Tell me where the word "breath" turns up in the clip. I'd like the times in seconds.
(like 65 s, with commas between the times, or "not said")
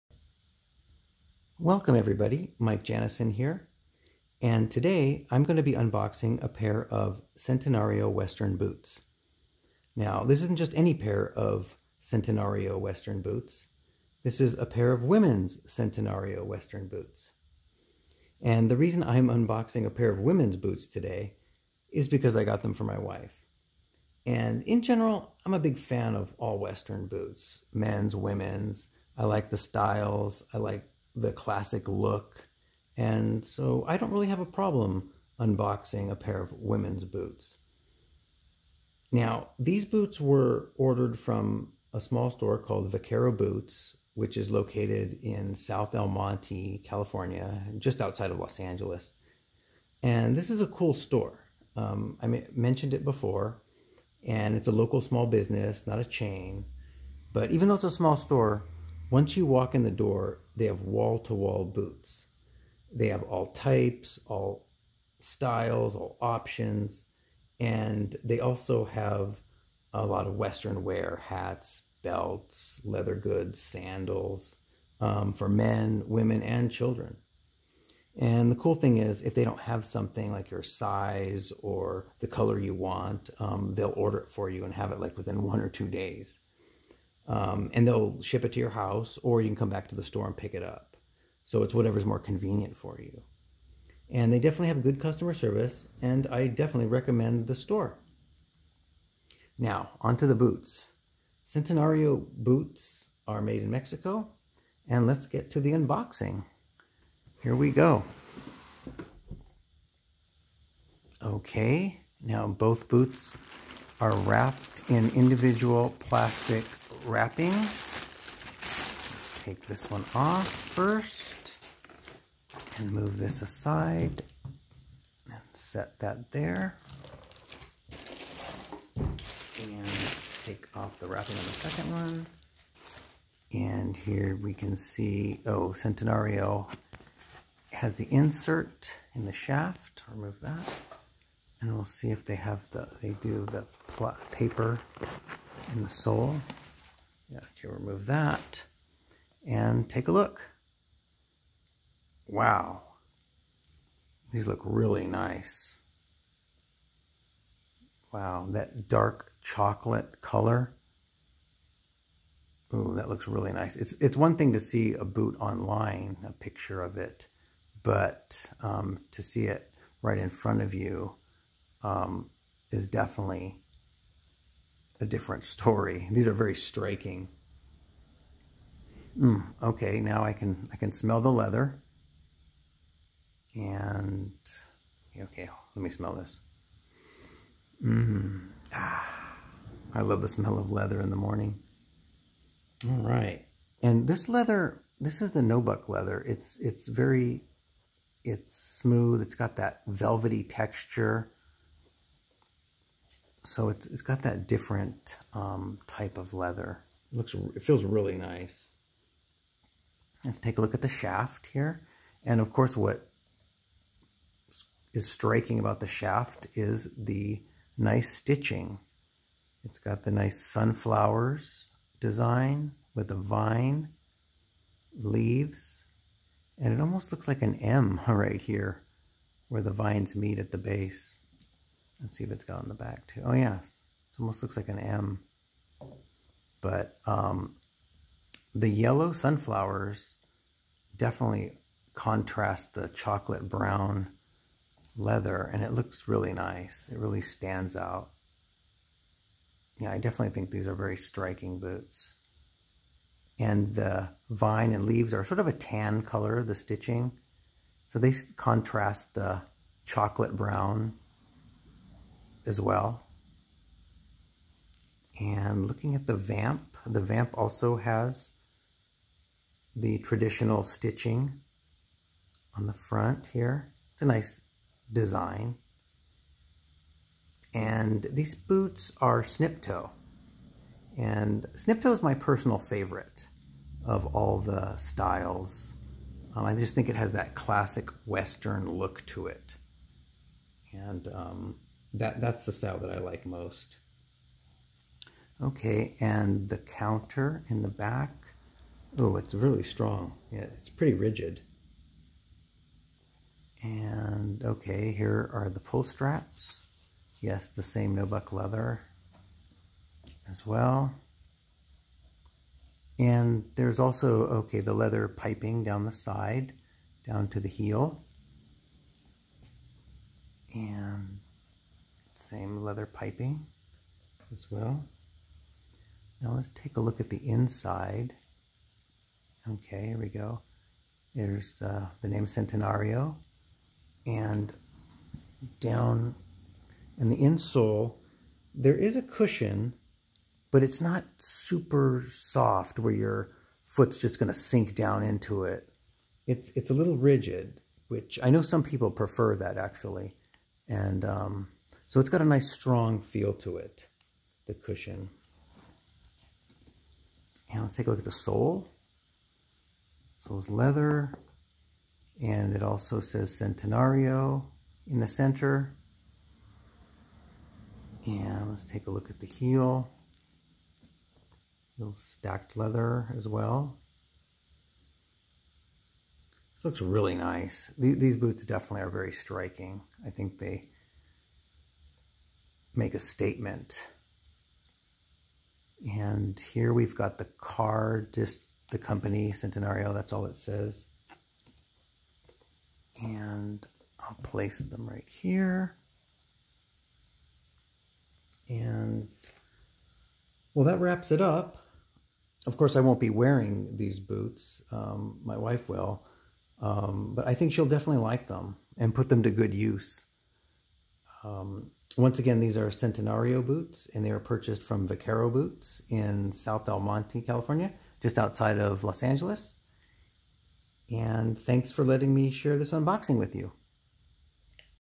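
not said.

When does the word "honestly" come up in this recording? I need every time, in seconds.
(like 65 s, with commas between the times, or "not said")
not said.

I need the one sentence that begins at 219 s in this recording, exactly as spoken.
It's got the nice sunflowers design with the vine leaves.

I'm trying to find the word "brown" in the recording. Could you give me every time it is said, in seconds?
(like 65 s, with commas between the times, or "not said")
243 s, 260 s.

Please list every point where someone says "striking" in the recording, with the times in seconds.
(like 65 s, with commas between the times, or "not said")
176 s, 215 s, 250 s, 379 s.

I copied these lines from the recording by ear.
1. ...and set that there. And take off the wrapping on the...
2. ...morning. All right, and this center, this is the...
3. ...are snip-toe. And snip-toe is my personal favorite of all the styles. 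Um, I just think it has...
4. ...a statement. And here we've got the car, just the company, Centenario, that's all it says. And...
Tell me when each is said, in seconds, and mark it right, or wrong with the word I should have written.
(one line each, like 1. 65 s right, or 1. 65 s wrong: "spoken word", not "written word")
1. 125 s right
2. 191 s wrong: "leather", not "center"
3. 278 s right
4. 382 s right.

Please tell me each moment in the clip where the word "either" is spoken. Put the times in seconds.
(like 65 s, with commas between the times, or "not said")
not said.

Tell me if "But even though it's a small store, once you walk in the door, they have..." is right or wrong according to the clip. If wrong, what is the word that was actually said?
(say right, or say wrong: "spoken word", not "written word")
right.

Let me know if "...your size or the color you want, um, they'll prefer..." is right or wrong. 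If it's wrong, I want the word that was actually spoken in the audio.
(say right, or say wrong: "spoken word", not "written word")
wrong: "order", not "prefer".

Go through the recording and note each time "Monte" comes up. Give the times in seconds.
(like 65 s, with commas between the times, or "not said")
46 s, 416 s.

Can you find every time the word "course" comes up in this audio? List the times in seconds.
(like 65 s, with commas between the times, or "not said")
212 s, 402 s.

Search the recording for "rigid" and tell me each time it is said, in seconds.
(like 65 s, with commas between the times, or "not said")
300 s, 346 s.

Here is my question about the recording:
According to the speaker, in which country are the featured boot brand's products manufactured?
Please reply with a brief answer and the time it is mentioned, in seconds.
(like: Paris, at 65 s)
Mexico, at 103 s.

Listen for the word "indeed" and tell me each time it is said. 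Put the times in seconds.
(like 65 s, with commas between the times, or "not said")
not said.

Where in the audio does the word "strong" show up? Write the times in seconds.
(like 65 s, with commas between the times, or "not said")
299 s, 352 s.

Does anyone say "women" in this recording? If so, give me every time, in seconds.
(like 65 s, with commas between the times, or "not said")
15 s, 20 s, 28 s, 36 s, 76 s.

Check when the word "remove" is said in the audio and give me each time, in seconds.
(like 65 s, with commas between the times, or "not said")
140 s, 147 s.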